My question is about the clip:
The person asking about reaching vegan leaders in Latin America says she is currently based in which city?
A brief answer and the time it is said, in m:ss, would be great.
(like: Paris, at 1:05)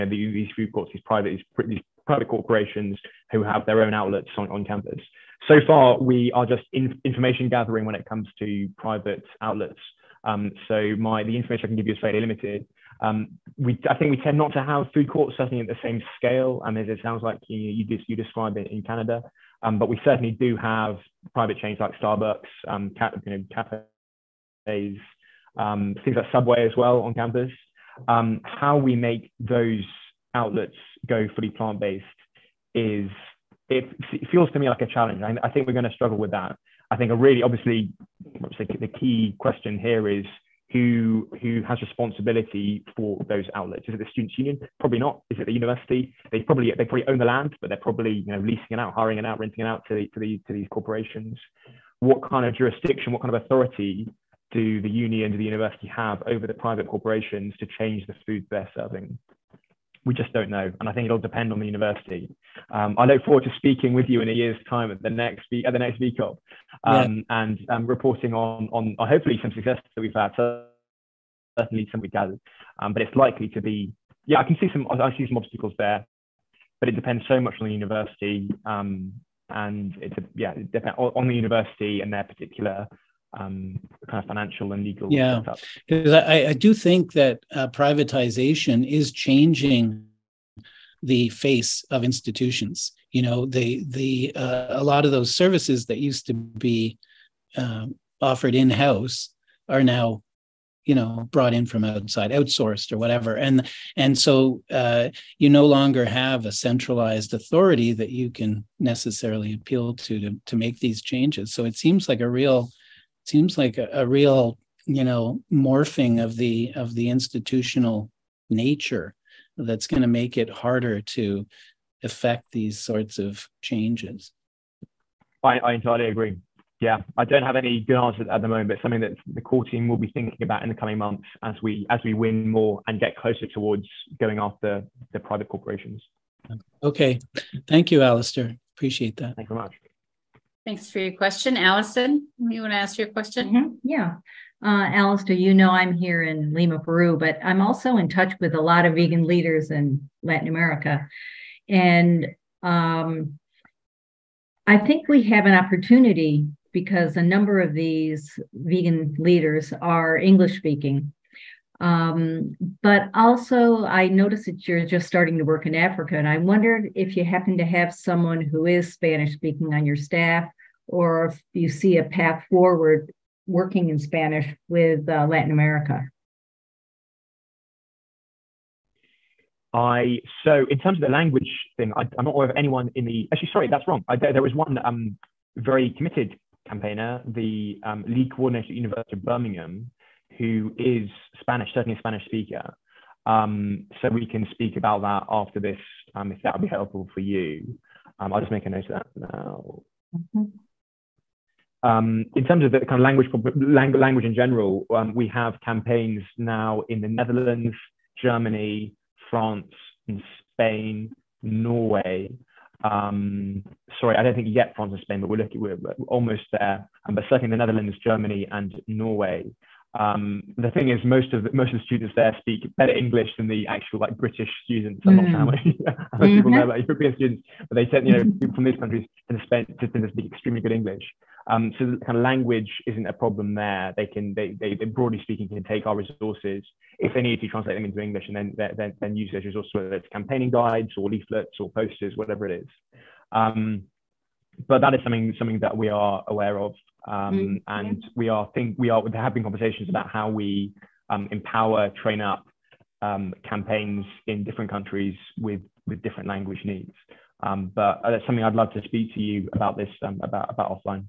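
Lima, Peru, at 2:26.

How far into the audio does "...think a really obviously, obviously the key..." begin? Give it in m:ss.
0:36.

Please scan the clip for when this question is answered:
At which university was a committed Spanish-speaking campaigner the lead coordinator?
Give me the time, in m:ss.
3:08.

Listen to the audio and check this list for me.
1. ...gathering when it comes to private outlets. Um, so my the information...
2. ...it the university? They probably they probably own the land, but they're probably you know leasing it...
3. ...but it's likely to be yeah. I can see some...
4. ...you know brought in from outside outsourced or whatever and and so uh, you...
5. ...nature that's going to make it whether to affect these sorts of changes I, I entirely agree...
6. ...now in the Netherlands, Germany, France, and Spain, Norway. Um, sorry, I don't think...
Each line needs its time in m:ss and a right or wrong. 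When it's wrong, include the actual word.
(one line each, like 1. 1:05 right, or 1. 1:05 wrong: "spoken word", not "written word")
1. 0:07 right
2. 0:45 right
3. 1:12 right
4. 1:40 right
5. 1:58 wrong: "harder", not "whether"
6. 3:26 right.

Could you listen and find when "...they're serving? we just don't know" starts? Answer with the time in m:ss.
0:58.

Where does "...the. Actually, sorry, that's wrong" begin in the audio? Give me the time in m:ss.
3:03.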